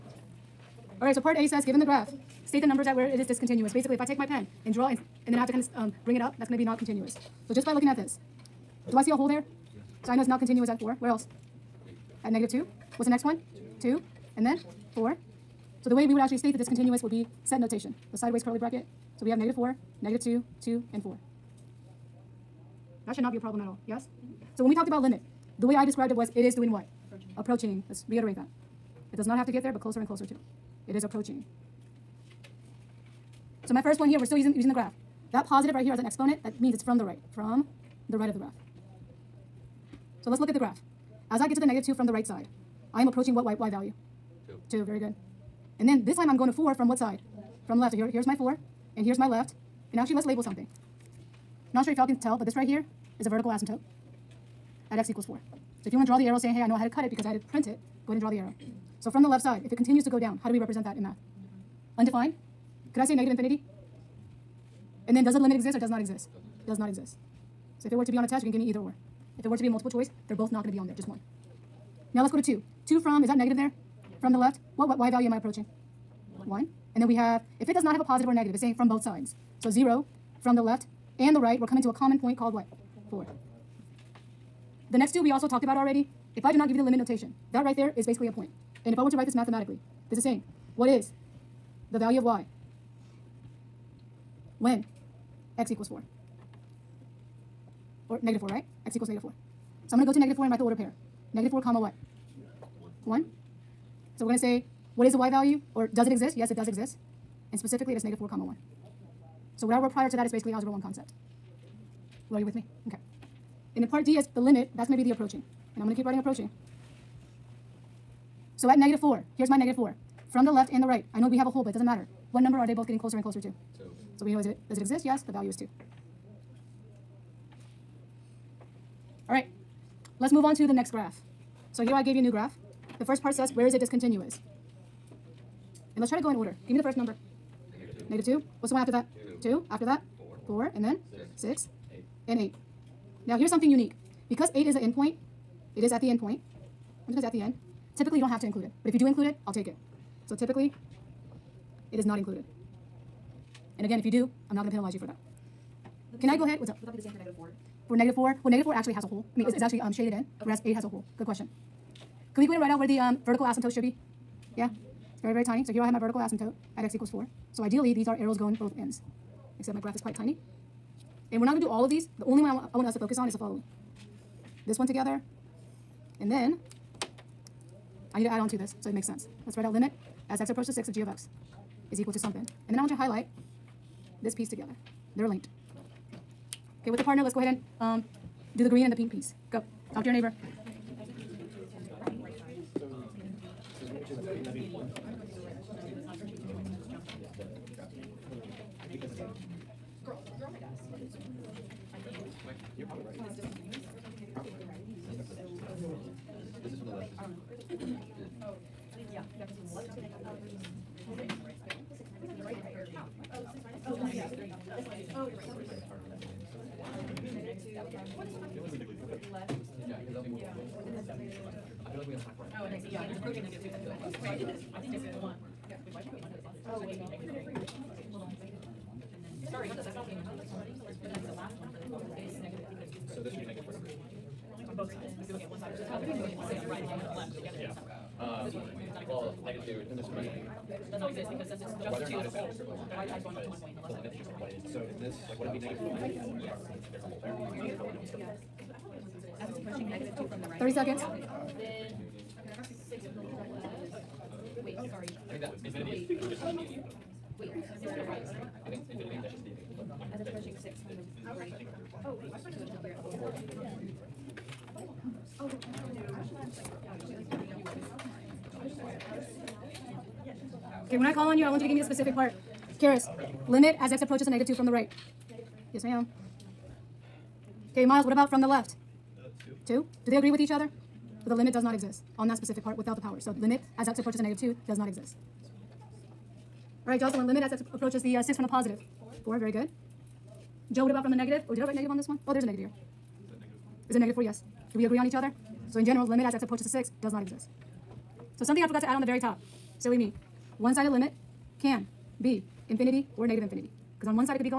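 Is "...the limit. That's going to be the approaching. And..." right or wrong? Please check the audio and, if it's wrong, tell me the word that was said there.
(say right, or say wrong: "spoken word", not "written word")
right.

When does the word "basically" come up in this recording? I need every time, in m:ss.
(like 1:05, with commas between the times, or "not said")
0:03, 1:28, 1:50.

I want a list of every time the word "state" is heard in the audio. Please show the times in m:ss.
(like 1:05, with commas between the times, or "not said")
0:02, 0:16.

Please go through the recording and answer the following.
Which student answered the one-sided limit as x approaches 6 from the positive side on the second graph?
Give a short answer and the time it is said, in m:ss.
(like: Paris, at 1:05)
Jocelyn, at 4:46.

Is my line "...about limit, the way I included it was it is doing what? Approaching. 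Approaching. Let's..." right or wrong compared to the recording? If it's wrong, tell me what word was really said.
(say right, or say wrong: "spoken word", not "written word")
wrong: "described", not "included".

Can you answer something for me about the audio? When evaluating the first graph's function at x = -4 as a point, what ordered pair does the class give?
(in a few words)
(-4, 1).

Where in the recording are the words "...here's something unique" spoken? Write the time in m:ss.
2:23.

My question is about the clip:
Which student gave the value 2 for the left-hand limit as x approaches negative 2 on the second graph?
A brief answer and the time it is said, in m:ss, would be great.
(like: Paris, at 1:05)
Miles, at 4:37.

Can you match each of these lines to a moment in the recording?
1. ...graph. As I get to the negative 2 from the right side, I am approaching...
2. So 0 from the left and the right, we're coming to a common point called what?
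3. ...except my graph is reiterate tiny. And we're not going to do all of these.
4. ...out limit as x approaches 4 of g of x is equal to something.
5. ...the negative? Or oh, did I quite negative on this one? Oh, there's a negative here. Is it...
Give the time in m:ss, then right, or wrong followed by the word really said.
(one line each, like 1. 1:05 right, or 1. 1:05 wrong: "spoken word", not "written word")
1. 0:40 right
2. 1:19 right
3. 2:49 wrong: "quite", not "reiterate"
4. 2:59 wrong: "6", not "4"
5. 4:51 wrong: "write", not "quite".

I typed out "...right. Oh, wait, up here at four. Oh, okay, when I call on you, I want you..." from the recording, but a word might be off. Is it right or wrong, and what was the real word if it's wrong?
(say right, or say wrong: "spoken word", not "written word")
right.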